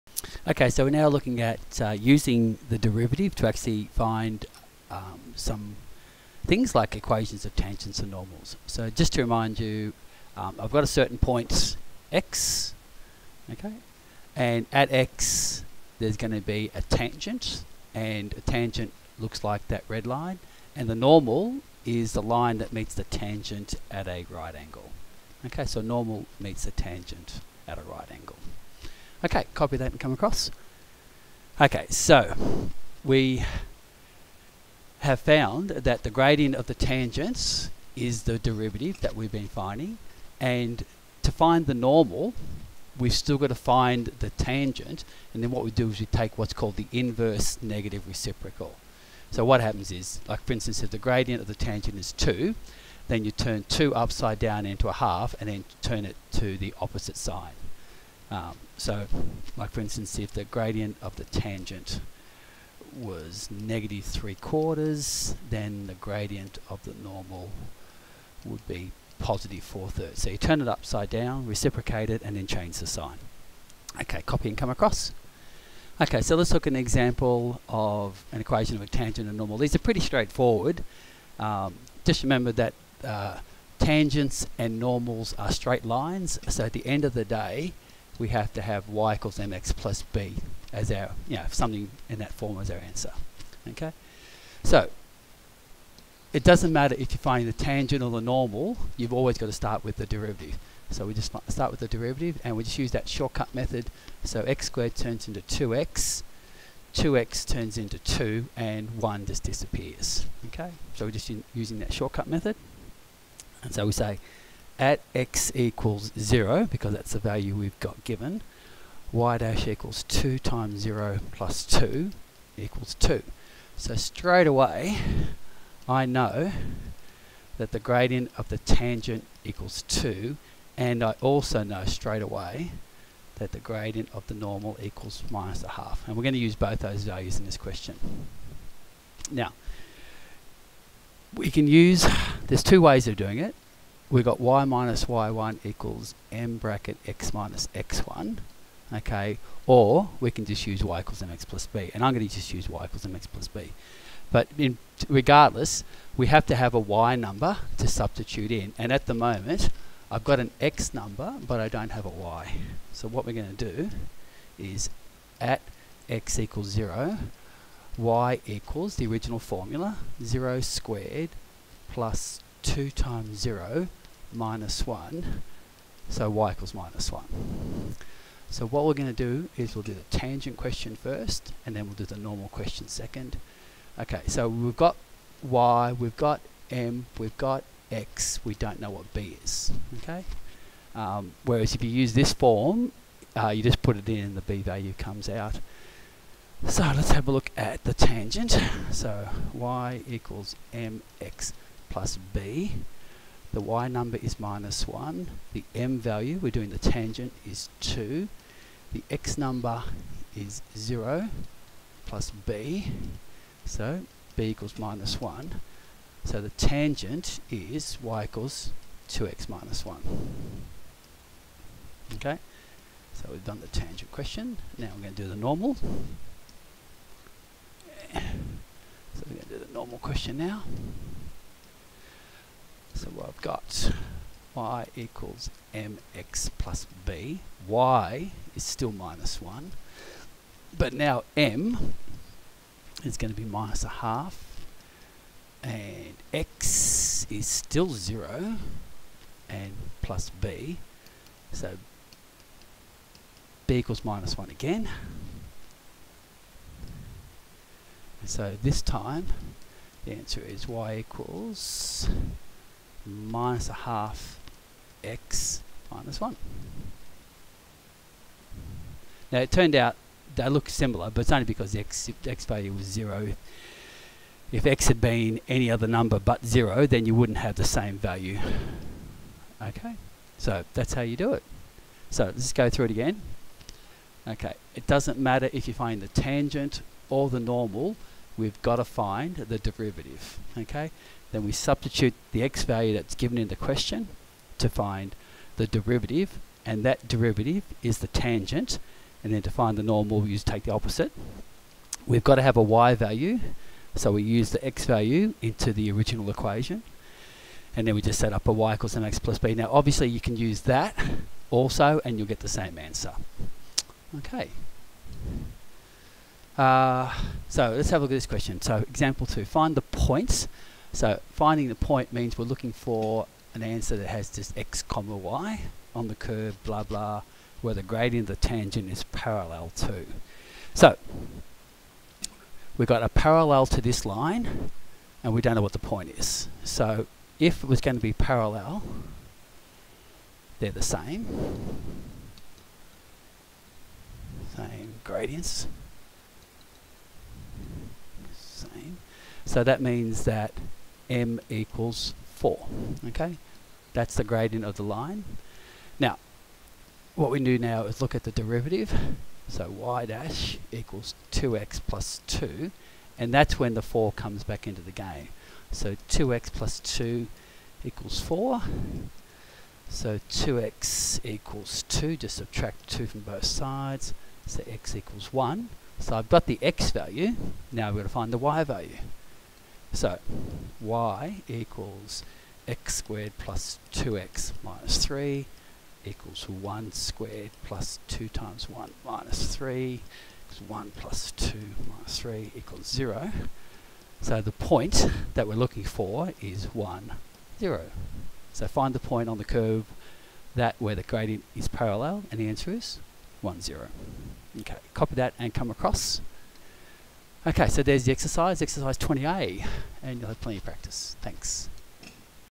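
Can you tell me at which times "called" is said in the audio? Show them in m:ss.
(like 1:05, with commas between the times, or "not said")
0:46.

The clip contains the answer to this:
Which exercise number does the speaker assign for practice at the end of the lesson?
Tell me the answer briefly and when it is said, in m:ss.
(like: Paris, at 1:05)
20A, at 6:48.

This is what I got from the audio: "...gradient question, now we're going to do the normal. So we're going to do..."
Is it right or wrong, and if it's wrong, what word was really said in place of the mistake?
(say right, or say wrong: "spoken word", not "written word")
wrong: "tangent", not "gradient".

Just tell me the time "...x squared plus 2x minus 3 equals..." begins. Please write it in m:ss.
6:22.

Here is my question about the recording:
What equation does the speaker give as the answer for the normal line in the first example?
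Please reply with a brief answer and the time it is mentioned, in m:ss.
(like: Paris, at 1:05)
y = -1/2x - 1, at 4:20.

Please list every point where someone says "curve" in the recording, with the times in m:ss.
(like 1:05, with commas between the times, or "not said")
5:26, 6:39.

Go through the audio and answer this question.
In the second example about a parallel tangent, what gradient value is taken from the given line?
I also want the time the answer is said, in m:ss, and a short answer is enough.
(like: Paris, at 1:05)
4, at 5:51.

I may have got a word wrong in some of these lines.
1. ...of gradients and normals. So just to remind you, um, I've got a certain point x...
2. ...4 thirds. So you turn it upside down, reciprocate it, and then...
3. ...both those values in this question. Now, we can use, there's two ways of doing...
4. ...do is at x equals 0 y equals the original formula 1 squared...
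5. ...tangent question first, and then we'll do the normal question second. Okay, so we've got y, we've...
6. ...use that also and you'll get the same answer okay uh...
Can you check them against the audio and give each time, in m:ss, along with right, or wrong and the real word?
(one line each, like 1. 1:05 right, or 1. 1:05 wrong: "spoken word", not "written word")
1. 0:07 wrong: "tangents", not "gradients"
2. 1:09 right
3. 2:16 right
4. 2:43 wrong: "0", not "1"
5. 3:00 right
6. 5:10 right.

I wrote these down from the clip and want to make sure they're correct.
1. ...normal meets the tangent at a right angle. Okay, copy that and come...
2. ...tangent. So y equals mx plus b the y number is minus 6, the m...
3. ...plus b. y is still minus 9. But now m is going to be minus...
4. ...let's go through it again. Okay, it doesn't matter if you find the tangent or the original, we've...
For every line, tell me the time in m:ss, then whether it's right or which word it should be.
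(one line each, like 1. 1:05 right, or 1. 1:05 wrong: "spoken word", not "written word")
1. 0:25 right
2. 3:17 wrong: "1", not "6"
3. 3:56 wrong: "1", not "9"
4. 4:42 wrong: "normal", not "original".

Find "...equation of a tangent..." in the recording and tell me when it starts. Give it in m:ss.
1:18.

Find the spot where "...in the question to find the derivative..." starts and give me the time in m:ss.
4:53.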